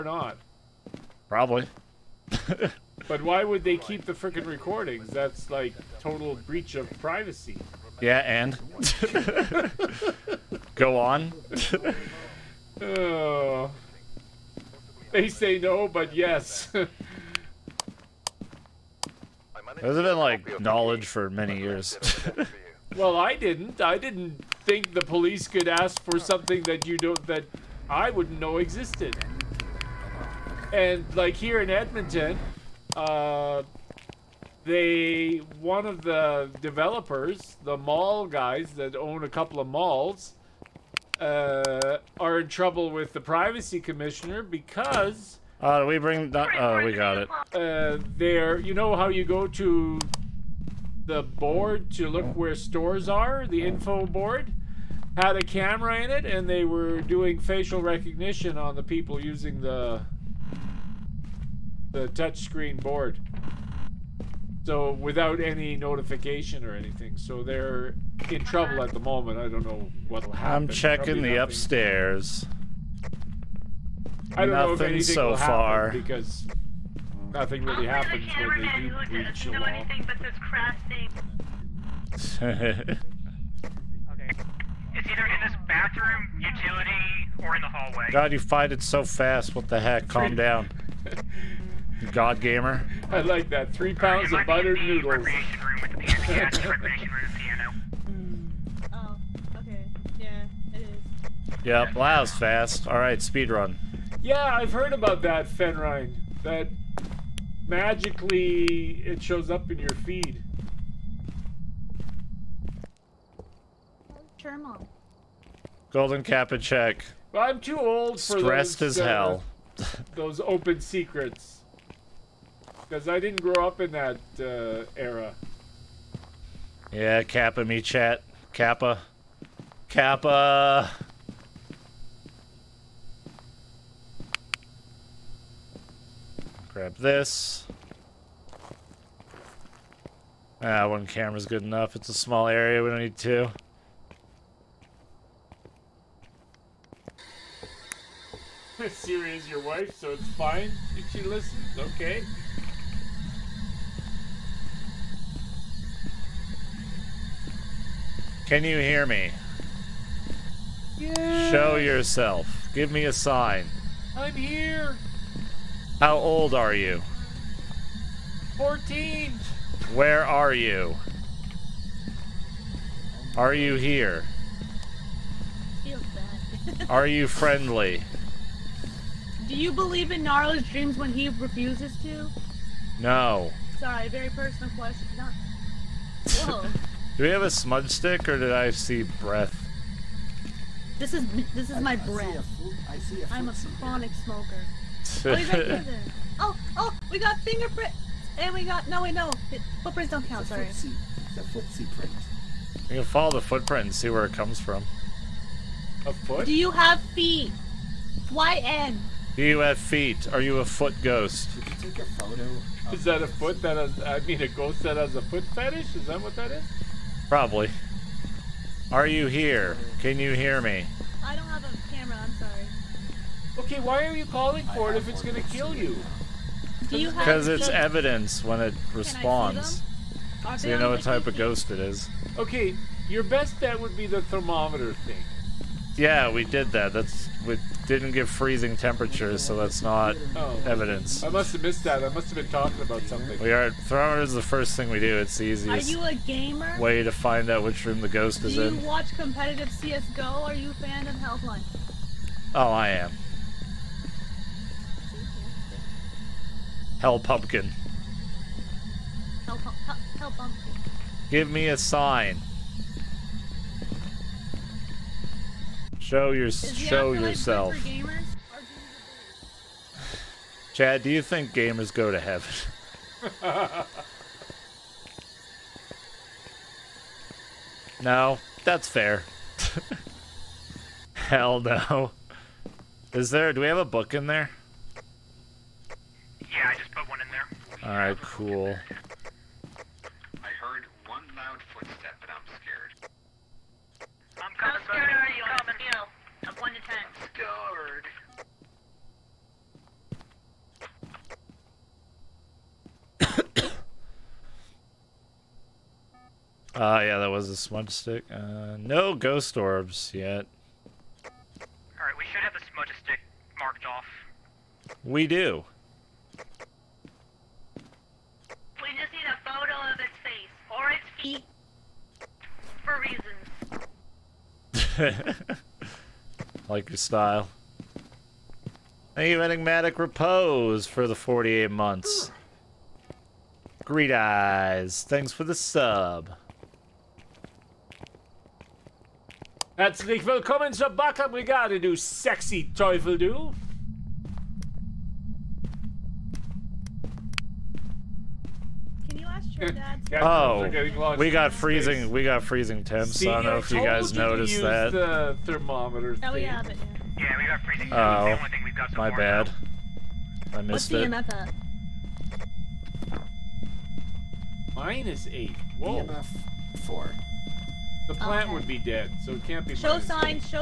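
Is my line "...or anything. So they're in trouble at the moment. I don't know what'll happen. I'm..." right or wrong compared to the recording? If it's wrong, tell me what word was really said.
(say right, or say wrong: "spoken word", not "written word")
right.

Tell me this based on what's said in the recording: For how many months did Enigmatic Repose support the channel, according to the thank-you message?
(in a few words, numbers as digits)
48.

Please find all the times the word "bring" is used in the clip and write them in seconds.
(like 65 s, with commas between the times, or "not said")
45 s.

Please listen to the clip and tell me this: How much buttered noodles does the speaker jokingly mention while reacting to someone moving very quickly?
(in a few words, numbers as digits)
3 pounds.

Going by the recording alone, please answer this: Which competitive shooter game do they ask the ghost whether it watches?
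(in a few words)
CS:GO.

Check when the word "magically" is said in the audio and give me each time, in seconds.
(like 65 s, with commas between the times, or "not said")
107 s.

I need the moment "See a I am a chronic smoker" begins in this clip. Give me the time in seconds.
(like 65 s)
193 s.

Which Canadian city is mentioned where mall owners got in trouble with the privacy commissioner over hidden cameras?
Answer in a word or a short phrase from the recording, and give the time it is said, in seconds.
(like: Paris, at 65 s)
Edmonton, at 31 s.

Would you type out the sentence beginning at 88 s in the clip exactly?
God, you fight it so fast.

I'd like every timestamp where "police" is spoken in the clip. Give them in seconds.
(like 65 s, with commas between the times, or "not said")
25 s.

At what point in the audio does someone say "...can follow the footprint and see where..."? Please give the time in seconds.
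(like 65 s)
202 s.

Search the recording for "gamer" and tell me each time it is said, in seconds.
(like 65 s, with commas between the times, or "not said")
92 s, 246 s, 271 s.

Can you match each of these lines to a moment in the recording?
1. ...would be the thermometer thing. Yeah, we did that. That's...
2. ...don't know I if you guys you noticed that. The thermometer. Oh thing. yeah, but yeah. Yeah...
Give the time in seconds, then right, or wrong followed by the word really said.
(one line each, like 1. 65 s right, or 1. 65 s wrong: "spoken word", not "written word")
1. 233 s right
2. 353 s right.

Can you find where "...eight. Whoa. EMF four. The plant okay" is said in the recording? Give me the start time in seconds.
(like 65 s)
365 s.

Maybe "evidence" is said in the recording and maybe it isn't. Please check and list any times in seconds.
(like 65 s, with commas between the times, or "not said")
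227 s, 240 s.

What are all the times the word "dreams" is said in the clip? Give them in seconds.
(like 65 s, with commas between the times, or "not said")
180 s.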